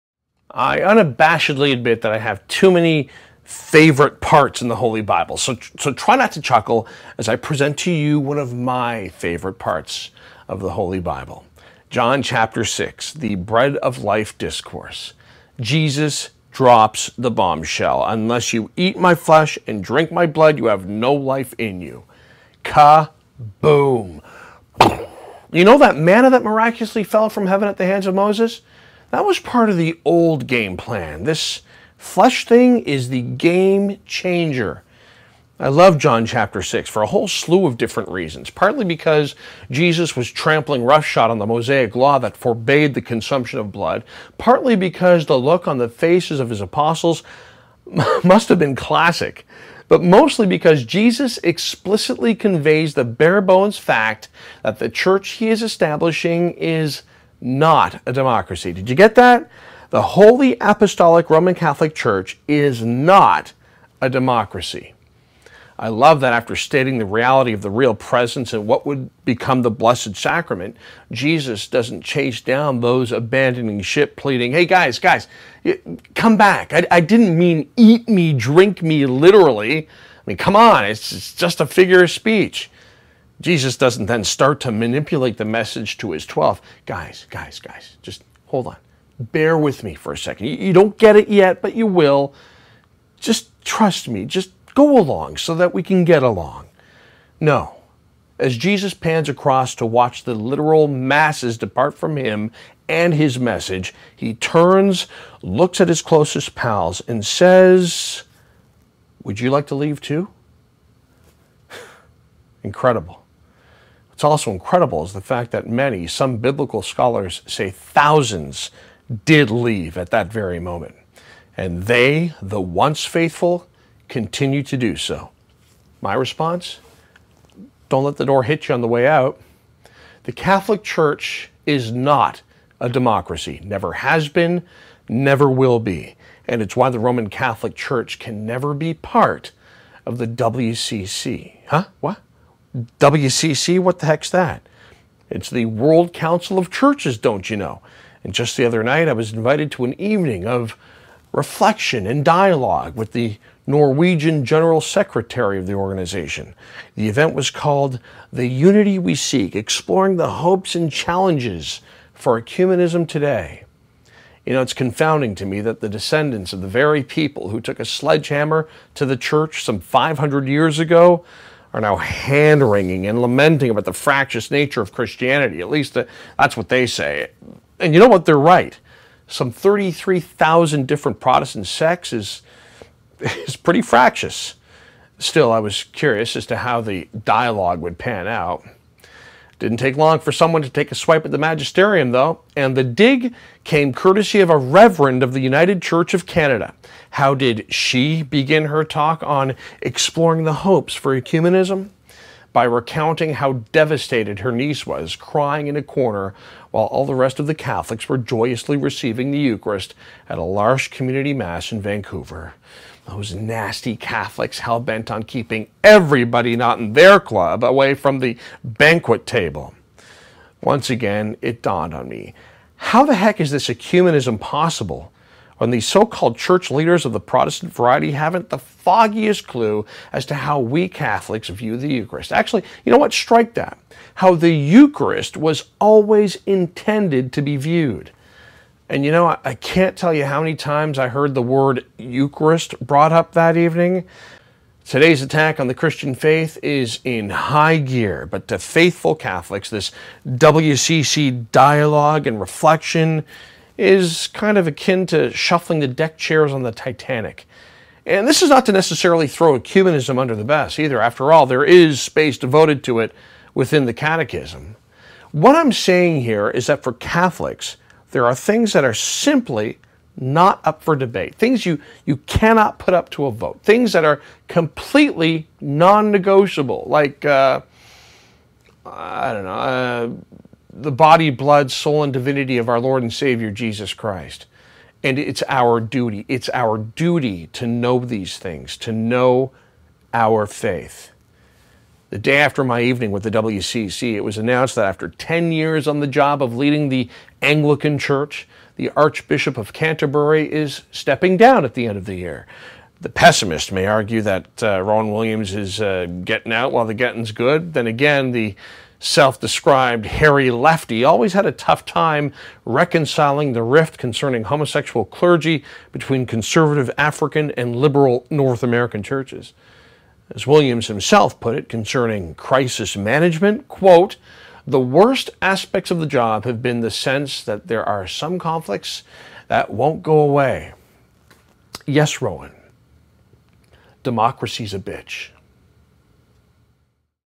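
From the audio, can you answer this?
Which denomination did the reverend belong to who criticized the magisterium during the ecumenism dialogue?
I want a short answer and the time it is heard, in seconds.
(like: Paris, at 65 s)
United Church of Canada, at 195 s.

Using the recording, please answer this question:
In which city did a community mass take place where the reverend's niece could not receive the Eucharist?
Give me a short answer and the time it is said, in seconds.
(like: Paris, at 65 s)
Vancouver, at 211 s.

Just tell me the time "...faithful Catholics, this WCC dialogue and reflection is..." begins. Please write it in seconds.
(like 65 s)
248 s.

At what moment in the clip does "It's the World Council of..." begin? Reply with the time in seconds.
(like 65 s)
145 s.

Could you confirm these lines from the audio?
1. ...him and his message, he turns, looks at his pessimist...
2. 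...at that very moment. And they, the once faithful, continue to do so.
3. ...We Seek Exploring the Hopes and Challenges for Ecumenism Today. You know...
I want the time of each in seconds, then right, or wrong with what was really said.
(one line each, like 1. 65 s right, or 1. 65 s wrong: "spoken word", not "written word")
1. 102 s wrong: "closest", not "pessimist"
2. 119 s right
3. 158 s right.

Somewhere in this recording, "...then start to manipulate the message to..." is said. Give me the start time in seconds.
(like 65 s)
84 s.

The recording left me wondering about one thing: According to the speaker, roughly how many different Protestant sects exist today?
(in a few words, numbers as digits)
33,000.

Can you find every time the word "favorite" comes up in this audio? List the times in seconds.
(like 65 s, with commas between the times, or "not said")
3 s, 9 s.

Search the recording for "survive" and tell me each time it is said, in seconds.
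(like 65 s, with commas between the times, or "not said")
not said.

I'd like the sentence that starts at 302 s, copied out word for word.
The pessimist may argue that uh, Rowan Williams is uh, getting out while the getting's good.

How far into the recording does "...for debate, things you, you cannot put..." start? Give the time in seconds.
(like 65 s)
270 s.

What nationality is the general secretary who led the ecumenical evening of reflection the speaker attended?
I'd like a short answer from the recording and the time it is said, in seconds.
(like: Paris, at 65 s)
Norwegian, at 153 s.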